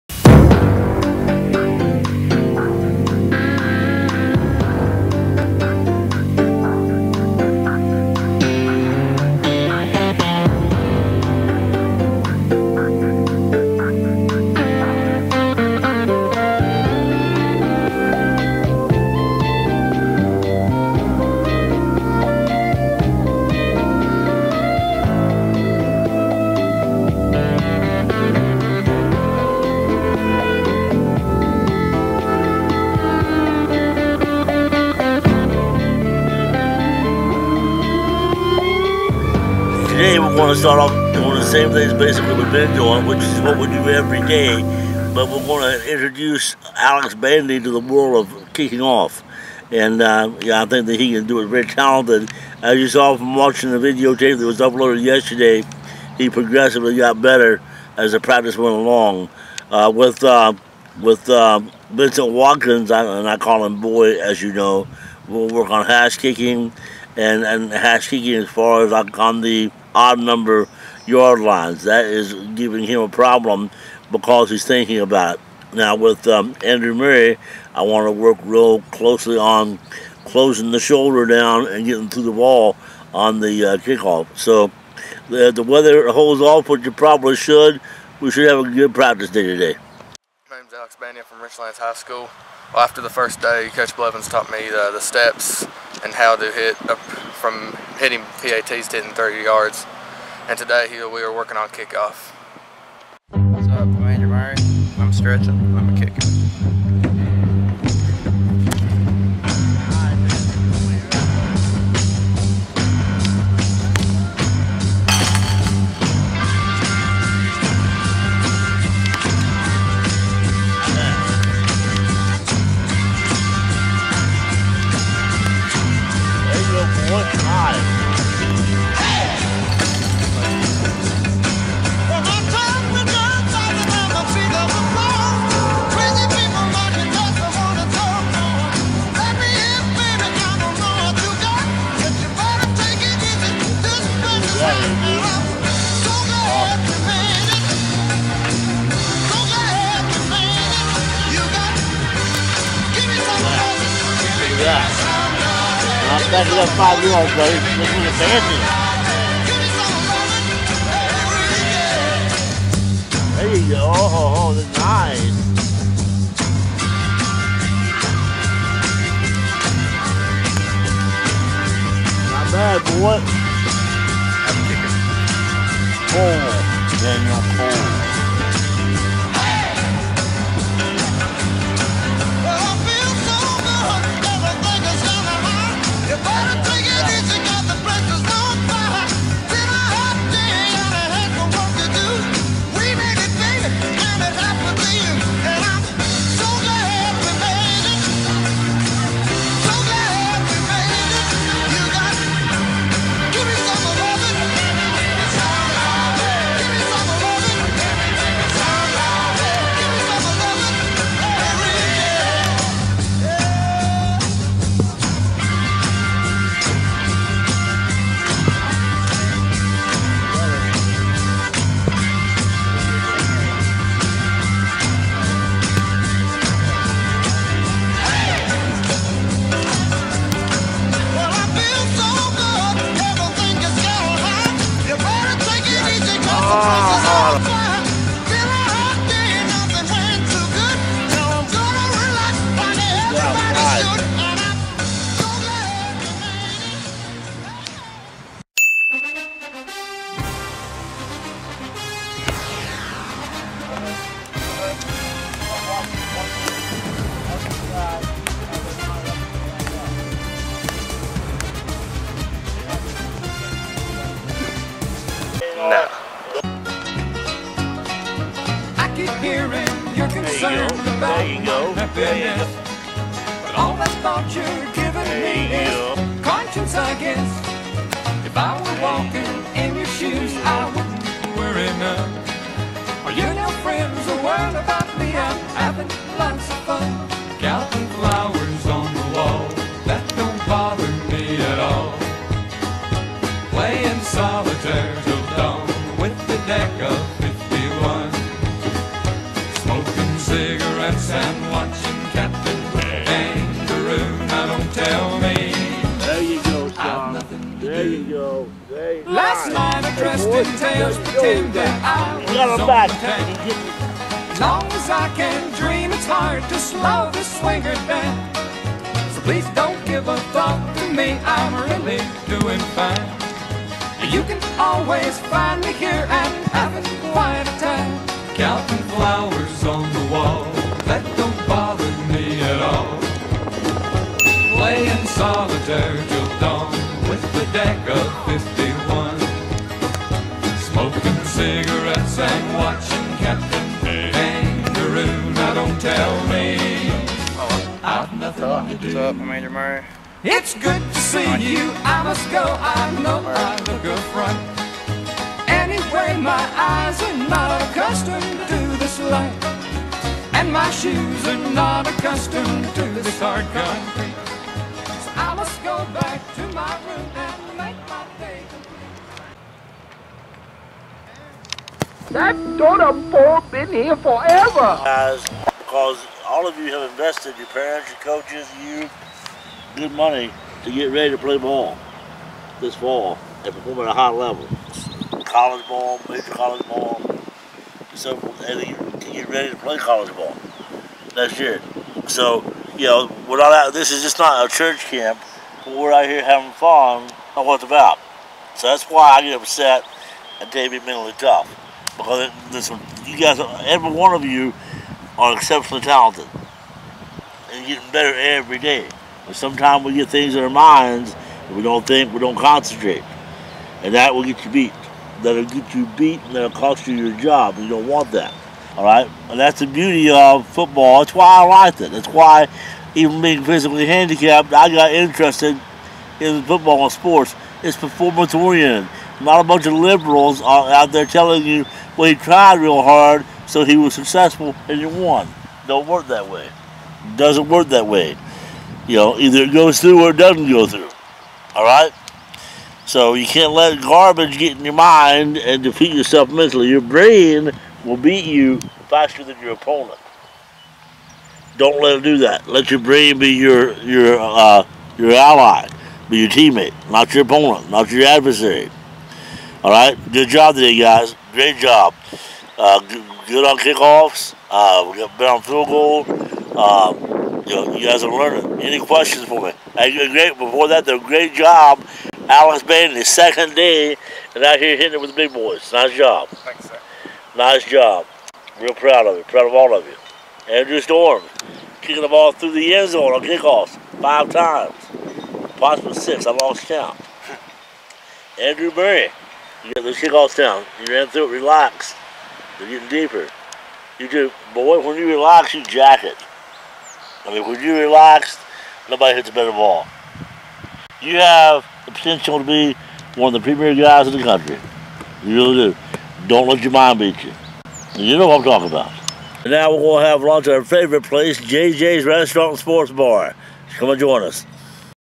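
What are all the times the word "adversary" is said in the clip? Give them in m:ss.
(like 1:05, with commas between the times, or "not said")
7:38.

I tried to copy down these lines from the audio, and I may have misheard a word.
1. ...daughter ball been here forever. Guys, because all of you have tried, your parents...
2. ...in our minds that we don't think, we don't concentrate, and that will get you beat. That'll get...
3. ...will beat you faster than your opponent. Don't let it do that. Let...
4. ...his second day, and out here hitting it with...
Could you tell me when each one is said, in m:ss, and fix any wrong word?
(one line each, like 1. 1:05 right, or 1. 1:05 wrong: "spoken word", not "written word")
1. 6:12 wrong: "invested", not "tried"
2. 6:50 right
3. 7:27 right
4. 7:52 right.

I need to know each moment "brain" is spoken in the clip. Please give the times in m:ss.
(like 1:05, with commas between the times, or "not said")
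7:26, 7:32.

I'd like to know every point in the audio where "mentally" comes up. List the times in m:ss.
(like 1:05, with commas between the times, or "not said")
6:40, 7:26.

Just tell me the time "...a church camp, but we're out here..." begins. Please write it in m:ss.
6:34.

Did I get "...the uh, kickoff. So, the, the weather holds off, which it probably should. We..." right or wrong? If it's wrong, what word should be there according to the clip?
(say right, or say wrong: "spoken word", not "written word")
right.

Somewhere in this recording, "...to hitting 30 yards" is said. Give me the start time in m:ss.
1:38.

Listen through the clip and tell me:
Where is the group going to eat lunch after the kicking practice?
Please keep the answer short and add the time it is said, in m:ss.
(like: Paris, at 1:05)
JJ's Restaurant and Sports Bar, at 8:31.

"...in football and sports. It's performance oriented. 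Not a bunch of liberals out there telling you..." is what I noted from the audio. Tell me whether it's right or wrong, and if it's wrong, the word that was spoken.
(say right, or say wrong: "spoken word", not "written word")
right.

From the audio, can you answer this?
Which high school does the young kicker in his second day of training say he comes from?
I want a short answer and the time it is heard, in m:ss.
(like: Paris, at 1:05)
Richlands High School, at 1:31.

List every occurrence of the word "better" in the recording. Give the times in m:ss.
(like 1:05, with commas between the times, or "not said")
0:57, 6:47, 7:45, 8:19.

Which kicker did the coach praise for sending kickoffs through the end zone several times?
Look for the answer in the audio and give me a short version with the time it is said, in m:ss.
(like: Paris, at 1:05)
Andrew Storm, at 8:00.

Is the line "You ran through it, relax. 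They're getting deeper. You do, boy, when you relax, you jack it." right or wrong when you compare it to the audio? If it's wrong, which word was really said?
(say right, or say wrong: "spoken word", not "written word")
right.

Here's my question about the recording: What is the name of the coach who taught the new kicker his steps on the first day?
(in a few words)
Coach Blevins.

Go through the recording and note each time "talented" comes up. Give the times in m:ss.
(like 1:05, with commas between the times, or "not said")
0:51, 6:45.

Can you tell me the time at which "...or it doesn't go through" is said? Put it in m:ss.
7:20.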